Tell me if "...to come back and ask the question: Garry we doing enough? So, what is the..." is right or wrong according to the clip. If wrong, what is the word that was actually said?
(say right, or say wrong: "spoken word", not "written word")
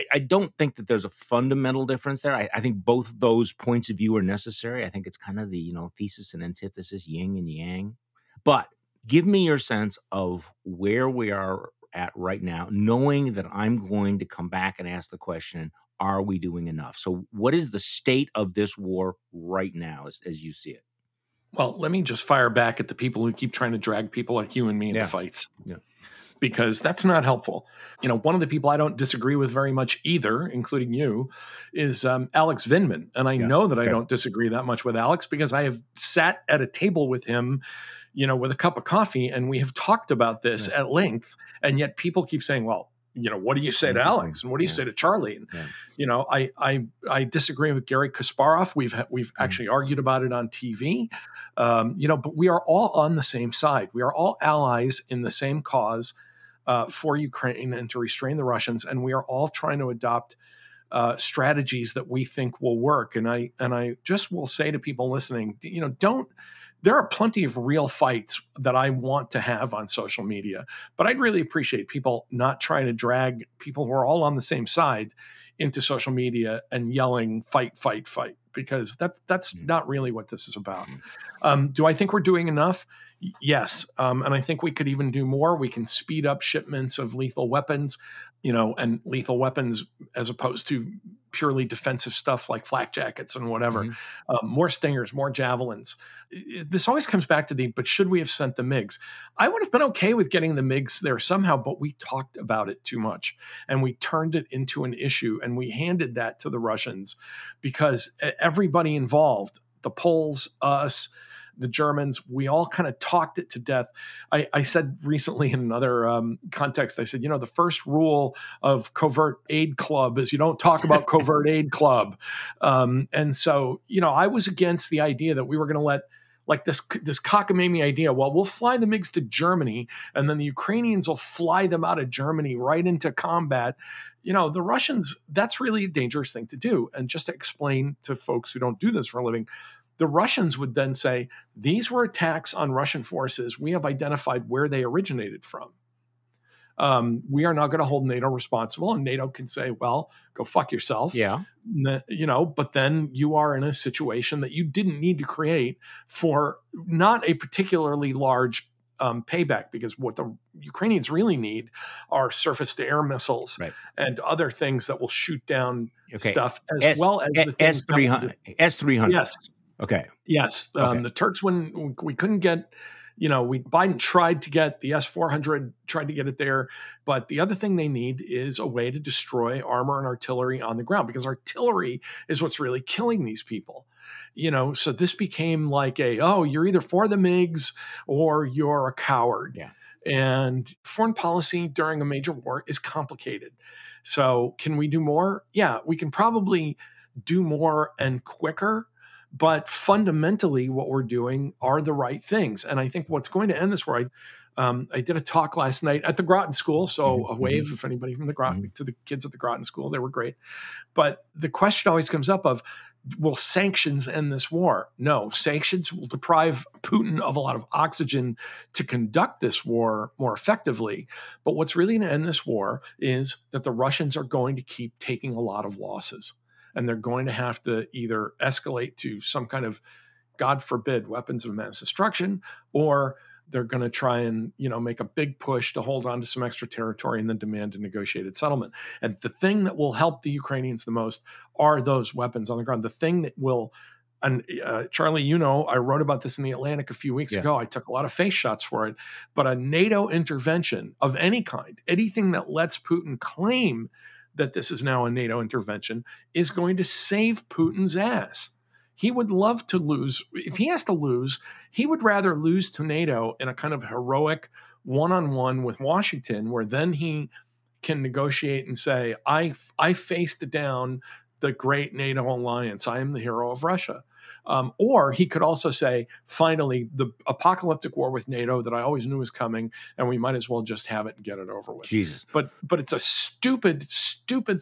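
wrong: "Are", not "Garry".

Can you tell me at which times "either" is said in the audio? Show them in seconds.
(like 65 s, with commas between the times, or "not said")
30 s, 186 s, 227 s.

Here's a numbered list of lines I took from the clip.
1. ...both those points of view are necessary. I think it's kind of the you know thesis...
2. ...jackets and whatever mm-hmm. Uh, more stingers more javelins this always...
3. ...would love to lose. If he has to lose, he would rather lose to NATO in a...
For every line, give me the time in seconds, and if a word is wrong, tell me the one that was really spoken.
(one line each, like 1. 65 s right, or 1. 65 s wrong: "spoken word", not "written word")
1. 2 s right
2. 92 s right
3. 259 s right.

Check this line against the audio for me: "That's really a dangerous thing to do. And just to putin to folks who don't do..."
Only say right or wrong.
wrong.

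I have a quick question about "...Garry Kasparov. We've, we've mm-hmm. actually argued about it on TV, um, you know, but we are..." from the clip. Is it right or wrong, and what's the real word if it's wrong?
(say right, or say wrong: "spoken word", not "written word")
right.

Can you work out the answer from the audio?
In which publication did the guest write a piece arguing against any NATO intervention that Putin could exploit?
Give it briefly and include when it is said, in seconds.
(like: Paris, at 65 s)
The Atlantic, at 246 s.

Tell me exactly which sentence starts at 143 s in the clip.
We have identified where they originated from.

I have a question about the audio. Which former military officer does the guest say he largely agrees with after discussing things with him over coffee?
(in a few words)
Alex Vindman.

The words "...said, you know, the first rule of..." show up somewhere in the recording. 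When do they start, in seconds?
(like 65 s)
117 s.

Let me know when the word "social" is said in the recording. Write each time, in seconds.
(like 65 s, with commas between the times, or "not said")
69 s, 75 s.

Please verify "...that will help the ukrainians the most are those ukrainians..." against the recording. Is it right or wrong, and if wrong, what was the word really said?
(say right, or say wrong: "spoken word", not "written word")
wrong: "weapons", not "ukrainians".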